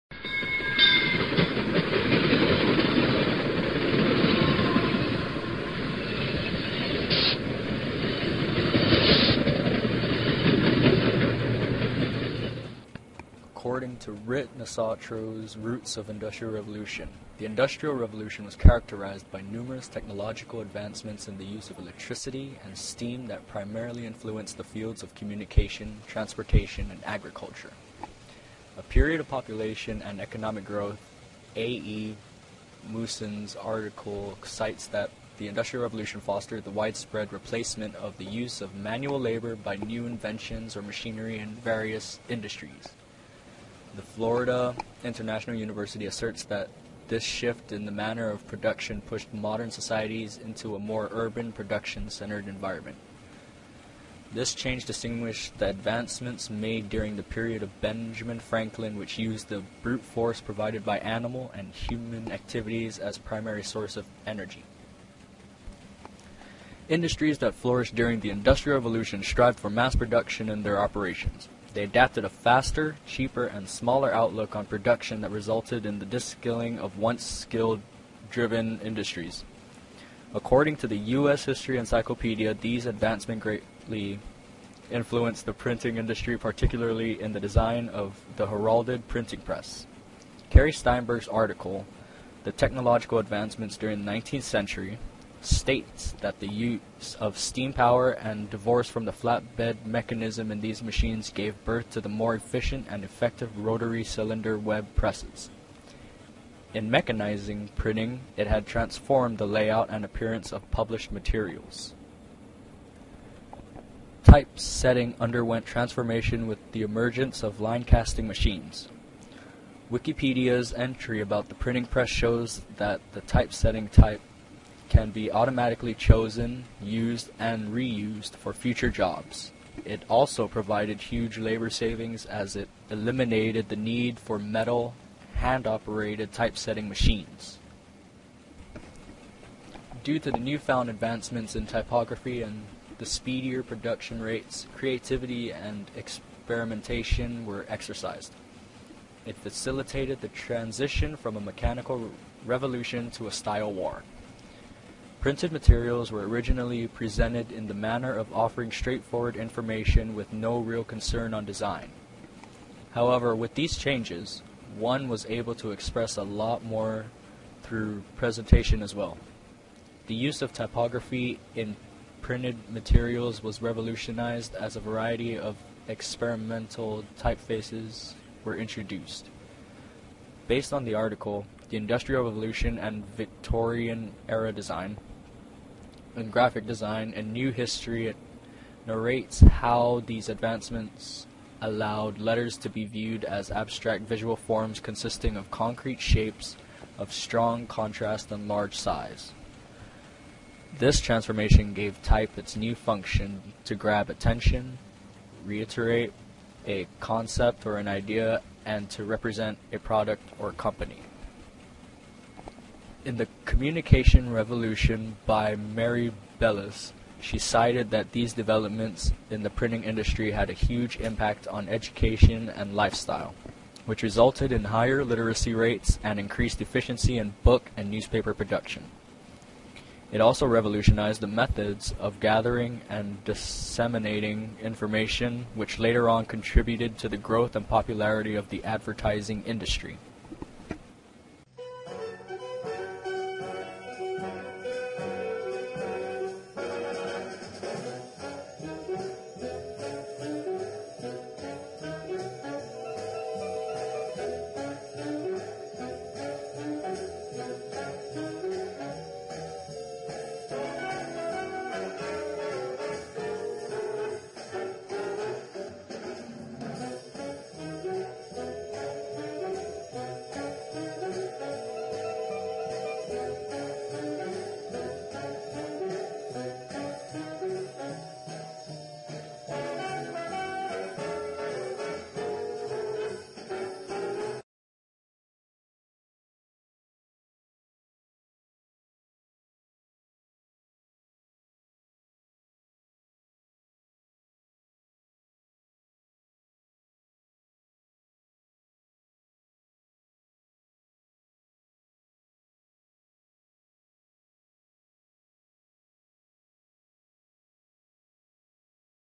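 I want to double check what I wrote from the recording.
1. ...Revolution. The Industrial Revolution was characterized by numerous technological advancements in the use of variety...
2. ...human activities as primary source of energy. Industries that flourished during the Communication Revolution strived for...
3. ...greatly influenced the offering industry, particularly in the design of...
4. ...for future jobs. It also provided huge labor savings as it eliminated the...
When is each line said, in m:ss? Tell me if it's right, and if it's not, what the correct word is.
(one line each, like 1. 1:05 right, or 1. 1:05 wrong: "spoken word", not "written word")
1. 0:16 wrong: "electricity", not "variety"
2. 1:01 wrong: "Industrial", not "Communication"
3. 1:23 wrong: "printing", not "offering"
4. 2:08 right.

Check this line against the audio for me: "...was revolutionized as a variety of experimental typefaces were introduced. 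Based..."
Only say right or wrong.
right.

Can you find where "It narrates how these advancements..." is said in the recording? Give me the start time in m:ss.
3:08.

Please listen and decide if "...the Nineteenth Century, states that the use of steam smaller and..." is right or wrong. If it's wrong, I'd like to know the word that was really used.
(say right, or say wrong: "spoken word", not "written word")
wrong: "power", not "smaller".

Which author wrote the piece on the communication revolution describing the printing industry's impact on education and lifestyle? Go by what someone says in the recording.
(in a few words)
Mary Bellis.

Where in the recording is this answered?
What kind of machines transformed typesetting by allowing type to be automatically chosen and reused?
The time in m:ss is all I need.
1:57.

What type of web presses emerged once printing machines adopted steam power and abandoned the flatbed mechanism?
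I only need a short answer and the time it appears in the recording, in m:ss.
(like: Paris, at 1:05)
rotary cylinder, at 1:43.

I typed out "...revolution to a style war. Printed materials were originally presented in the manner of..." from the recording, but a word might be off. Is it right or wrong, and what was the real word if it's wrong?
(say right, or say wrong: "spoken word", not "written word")
right.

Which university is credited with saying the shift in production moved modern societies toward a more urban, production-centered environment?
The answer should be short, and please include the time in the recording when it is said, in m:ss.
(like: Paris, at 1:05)
Florida International University, at 0:44.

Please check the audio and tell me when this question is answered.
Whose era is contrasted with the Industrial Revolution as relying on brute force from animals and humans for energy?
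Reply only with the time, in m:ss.
0:57.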